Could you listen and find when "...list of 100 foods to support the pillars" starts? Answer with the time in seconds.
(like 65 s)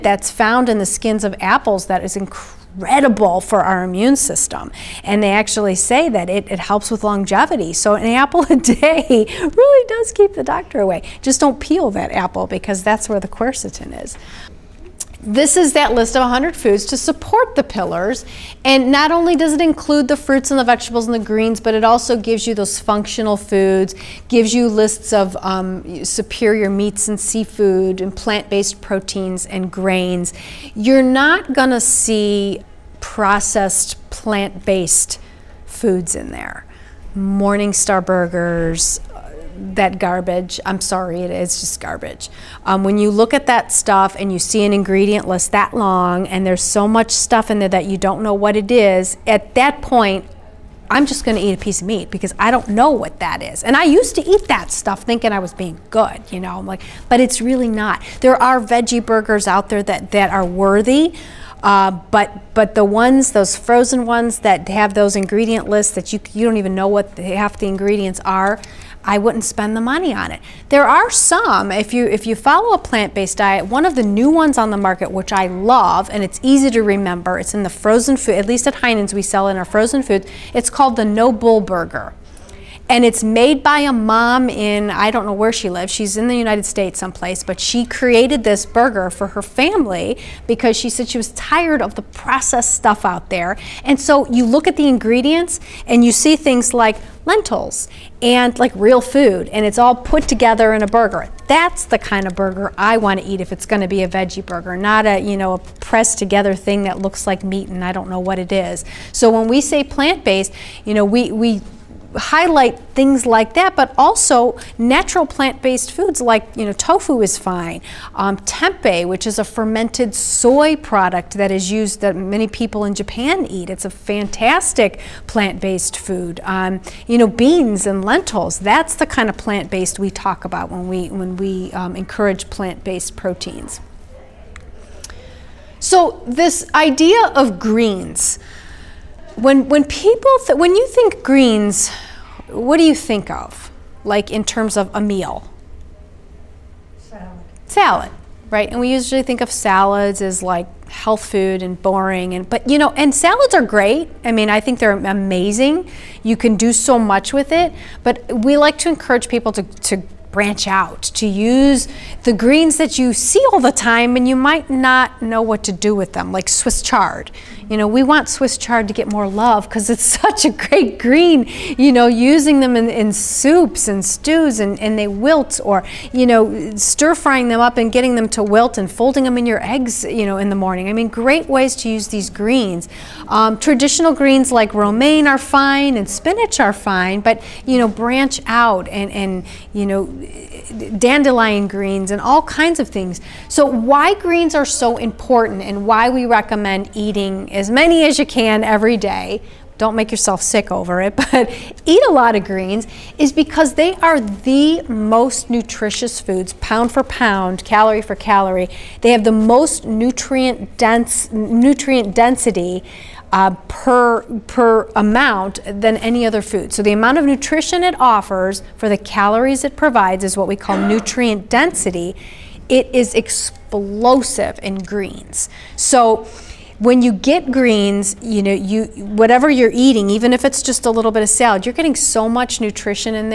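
15 s.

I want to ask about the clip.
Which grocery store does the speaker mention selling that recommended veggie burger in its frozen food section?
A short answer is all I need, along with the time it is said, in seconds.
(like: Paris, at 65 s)
Heinen's, at 78 s.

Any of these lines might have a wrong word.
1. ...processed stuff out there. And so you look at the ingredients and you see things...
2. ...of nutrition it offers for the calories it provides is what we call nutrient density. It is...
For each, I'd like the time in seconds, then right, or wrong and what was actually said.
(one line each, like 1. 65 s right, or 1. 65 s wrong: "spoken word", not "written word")
1. 92 s right
2. 217 s right.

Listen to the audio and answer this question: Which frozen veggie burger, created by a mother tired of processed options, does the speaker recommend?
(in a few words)
No Bull Burger.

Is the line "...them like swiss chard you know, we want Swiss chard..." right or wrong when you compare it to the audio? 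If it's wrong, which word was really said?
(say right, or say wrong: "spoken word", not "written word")
right.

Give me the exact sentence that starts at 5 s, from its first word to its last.
And they actually say that it, it helps with longevity.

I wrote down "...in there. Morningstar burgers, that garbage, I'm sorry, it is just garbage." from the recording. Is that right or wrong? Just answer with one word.
right.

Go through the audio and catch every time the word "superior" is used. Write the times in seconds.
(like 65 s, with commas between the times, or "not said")
26 s.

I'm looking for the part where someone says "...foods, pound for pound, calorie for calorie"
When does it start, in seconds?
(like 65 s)
206 s.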